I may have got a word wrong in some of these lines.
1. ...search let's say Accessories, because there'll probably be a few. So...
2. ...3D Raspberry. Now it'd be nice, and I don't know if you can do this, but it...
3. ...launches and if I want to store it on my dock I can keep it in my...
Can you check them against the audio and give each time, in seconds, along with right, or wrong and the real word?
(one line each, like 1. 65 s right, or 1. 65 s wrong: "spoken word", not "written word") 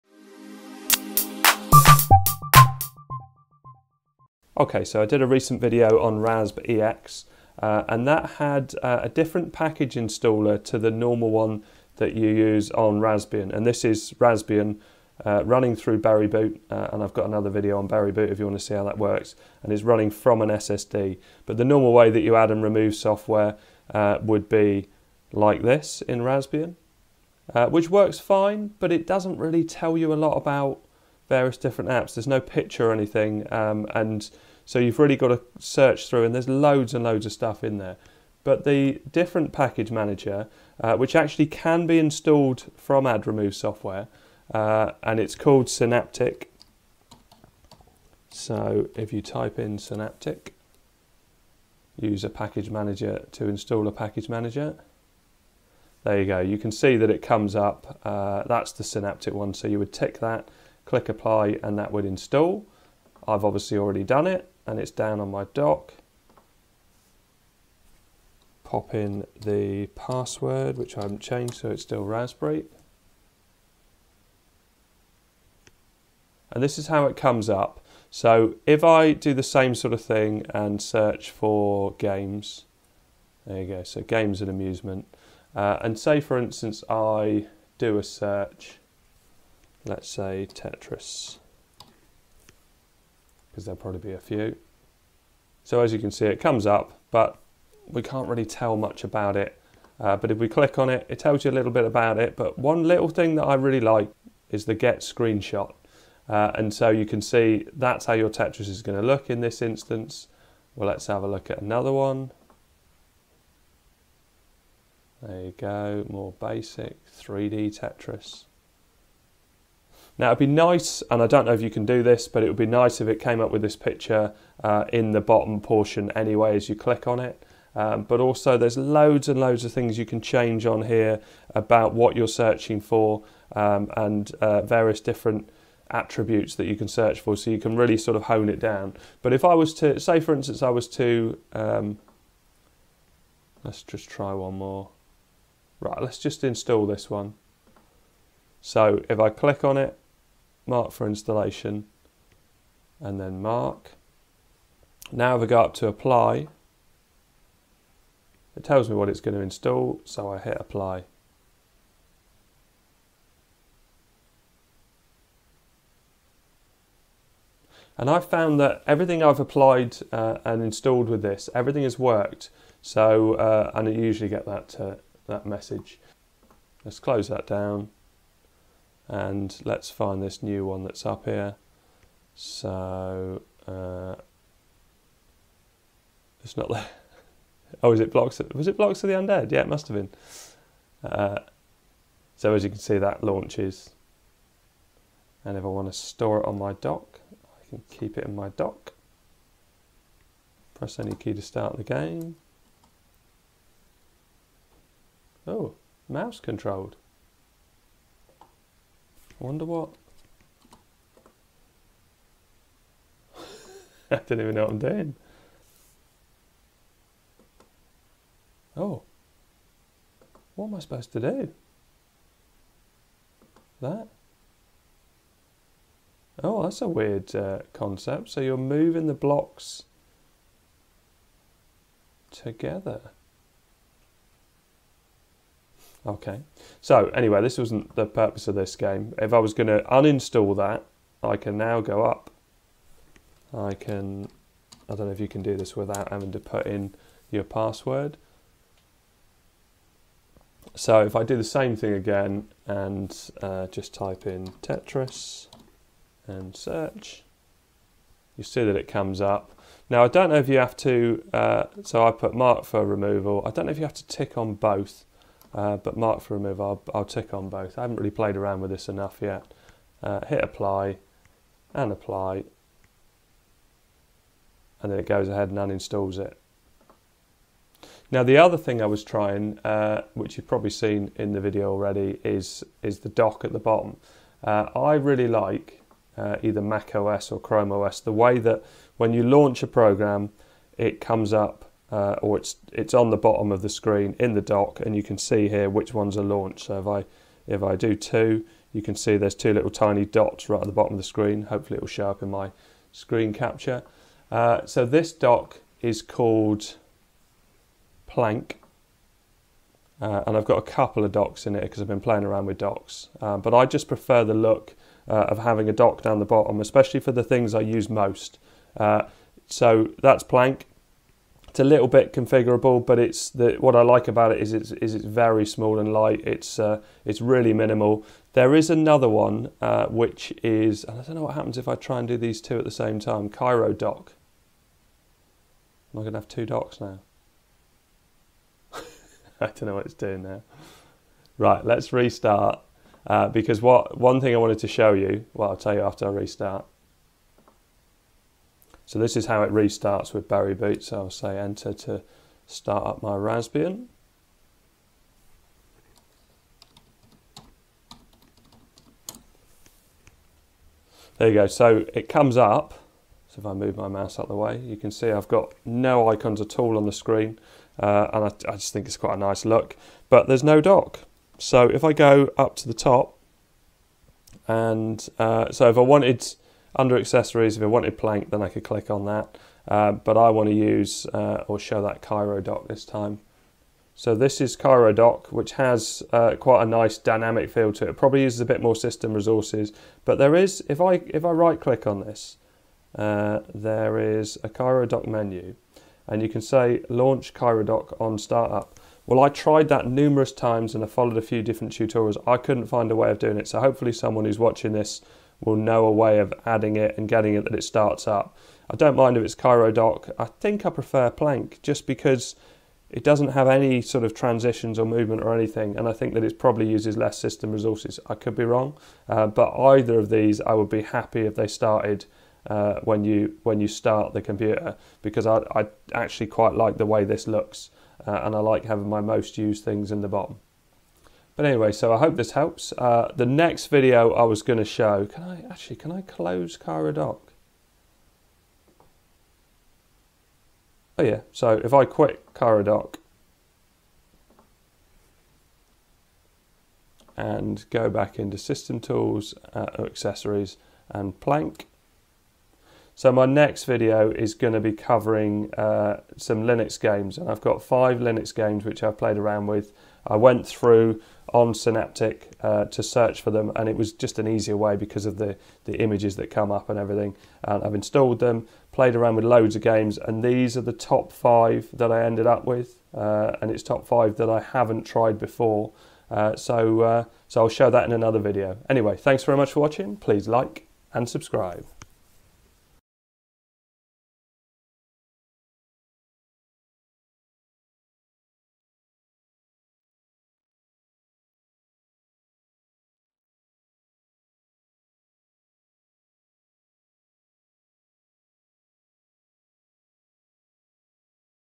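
1. 88 s wrong: "Tetris", not "Accessories"
2. 117 s wrong: "Tetris", not "Raspberry"
3. 193 s right.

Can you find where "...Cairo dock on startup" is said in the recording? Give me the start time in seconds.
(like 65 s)
397 s.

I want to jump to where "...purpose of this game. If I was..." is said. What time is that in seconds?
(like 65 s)
238 s.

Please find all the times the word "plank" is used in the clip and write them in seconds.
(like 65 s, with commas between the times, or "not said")
308 s, 320 s, 377 s, 411 s, 451 s.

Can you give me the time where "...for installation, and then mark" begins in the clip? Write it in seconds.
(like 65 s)
150 s.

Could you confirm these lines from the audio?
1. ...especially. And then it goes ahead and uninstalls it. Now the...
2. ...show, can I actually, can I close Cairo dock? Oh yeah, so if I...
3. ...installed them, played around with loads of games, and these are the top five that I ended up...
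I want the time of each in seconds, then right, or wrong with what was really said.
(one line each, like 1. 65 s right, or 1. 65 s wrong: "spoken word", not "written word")
1. 271 s wrong: "apply", not "especially"
2. 434 s right
3. 467 s right.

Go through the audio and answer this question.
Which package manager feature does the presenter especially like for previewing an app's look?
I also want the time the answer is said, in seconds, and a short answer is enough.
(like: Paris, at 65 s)
get screenshot, at 104 s.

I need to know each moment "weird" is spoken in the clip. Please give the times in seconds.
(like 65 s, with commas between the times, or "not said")
226 s.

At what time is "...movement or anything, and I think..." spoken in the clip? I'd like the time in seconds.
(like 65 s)
414 s.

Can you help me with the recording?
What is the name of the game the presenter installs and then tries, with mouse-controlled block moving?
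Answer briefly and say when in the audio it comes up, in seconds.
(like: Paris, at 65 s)
Blocks of the Undead, at 188 s.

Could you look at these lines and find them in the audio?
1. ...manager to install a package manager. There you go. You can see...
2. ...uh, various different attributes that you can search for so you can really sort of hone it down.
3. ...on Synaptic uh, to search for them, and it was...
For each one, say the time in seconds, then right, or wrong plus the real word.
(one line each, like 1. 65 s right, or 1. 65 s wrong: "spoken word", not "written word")
1. 52 s right
2. 134 s right
3. 461 s right.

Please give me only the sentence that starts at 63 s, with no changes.
I've obviously already done it and it's down on my dock.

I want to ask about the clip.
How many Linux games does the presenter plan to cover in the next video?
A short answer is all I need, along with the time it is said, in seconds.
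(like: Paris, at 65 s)
5, at 457 s.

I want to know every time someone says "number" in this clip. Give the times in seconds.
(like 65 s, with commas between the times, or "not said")
not said.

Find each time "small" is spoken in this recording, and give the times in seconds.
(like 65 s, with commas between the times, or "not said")
325 s.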